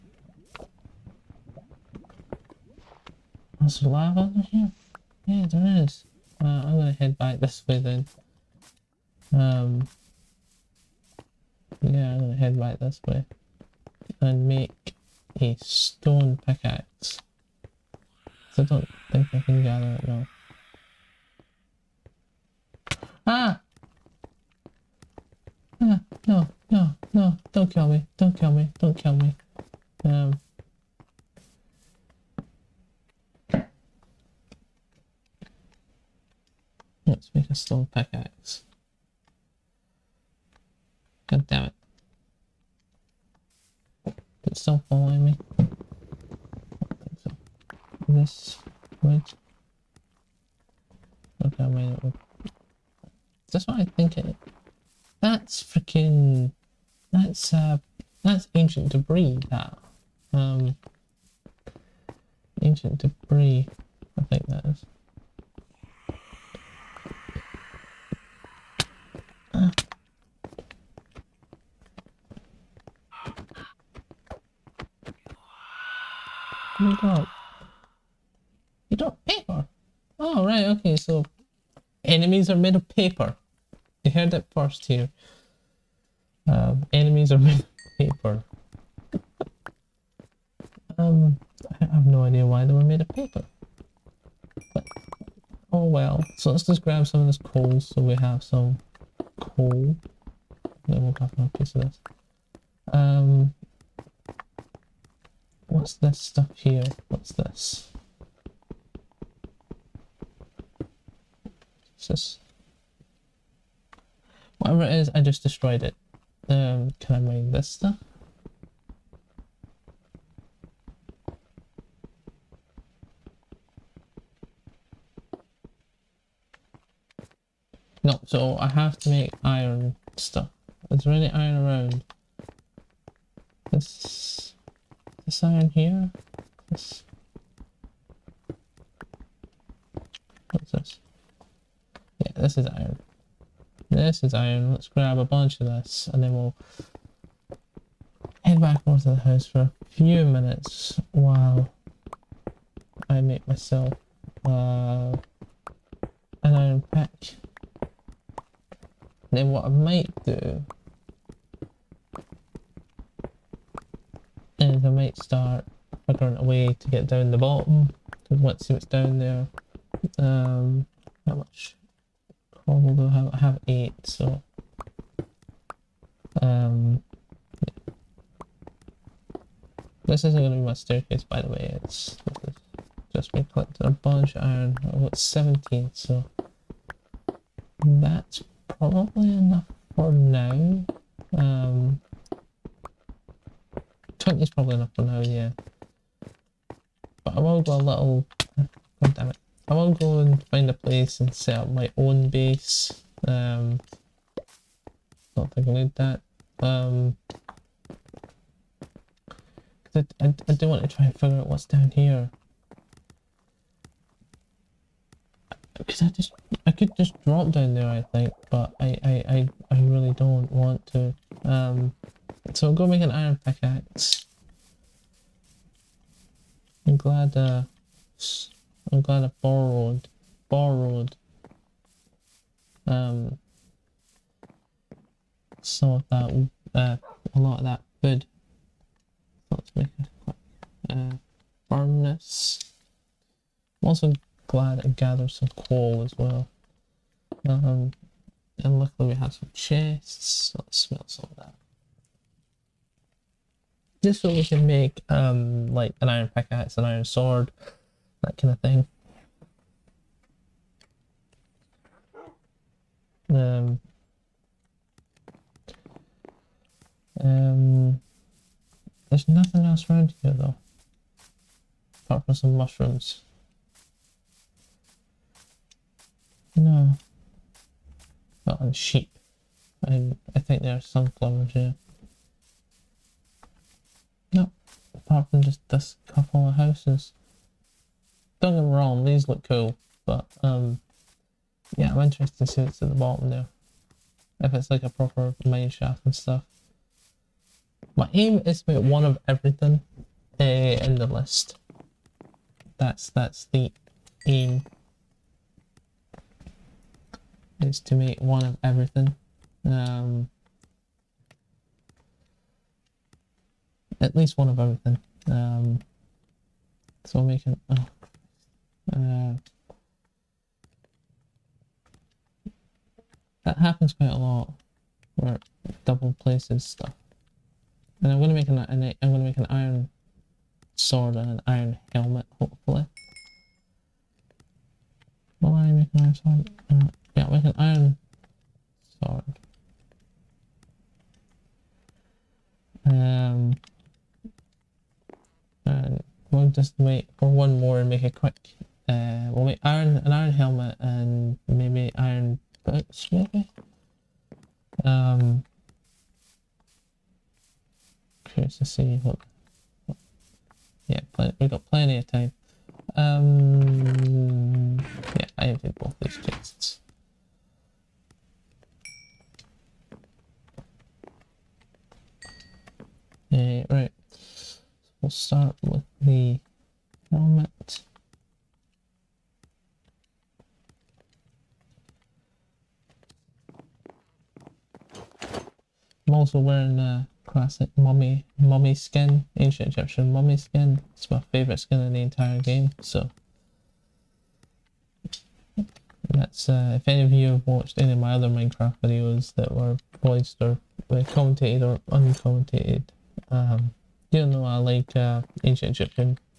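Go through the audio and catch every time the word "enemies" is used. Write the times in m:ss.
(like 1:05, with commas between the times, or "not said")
1:22, 1:26.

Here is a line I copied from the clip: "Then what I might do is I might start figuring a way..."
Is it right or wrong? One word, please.
right.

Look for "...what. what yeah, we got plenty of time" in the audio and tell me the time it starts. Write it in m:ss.
5:59.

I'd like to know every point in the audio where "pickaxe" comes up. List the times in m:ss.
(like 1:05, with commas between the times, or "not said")
0:16, 0:37, 3:43, 4:16.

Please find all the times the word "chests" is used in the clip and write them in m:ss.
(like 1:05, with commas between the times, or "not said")
4:09, 6:06.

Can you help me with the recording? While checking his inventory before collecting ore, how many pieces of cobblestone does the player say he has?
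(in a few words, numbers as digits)
8.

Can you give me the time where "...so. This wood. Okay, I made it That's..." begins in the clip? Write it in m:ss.
0:47.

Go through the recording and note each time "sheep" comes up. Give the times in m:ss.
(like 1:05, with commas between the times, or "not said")
4:38.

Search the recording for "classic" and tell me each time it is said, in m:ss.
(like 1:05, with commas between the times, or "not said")
6:27.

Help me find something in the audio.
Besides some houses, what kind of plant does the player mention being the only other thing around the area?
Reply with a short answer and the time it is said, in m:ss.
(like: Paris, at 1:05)
mushrooms, at 4:32.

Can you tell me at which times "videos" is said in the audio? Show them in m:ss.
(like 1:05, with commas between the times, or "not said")
6:38.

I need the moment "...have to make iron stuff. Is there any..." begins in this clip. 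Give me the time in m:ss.
2:08.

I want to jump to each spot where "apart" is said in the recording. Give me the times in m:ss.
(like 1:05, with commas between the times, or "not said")
4:32, 4:44.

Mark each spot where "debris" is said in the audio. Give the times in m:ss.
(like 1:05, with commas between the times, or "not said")
0:58, 1:02.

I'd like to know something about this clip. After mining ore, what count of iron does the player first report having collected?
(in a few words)
17.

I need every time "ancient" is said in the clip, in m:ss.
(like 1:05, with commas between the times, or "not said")
0:58, 1:02, 6:29, 6:45.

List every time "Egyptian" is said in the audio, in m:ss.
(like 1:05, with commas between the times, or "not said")
6:29, 6:45.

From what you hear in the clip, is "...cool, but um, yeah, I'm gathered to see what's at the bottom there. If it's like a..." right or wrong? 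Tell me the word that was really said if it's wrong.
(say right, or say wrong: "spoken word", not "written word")
wrong: "interested", not "gathered".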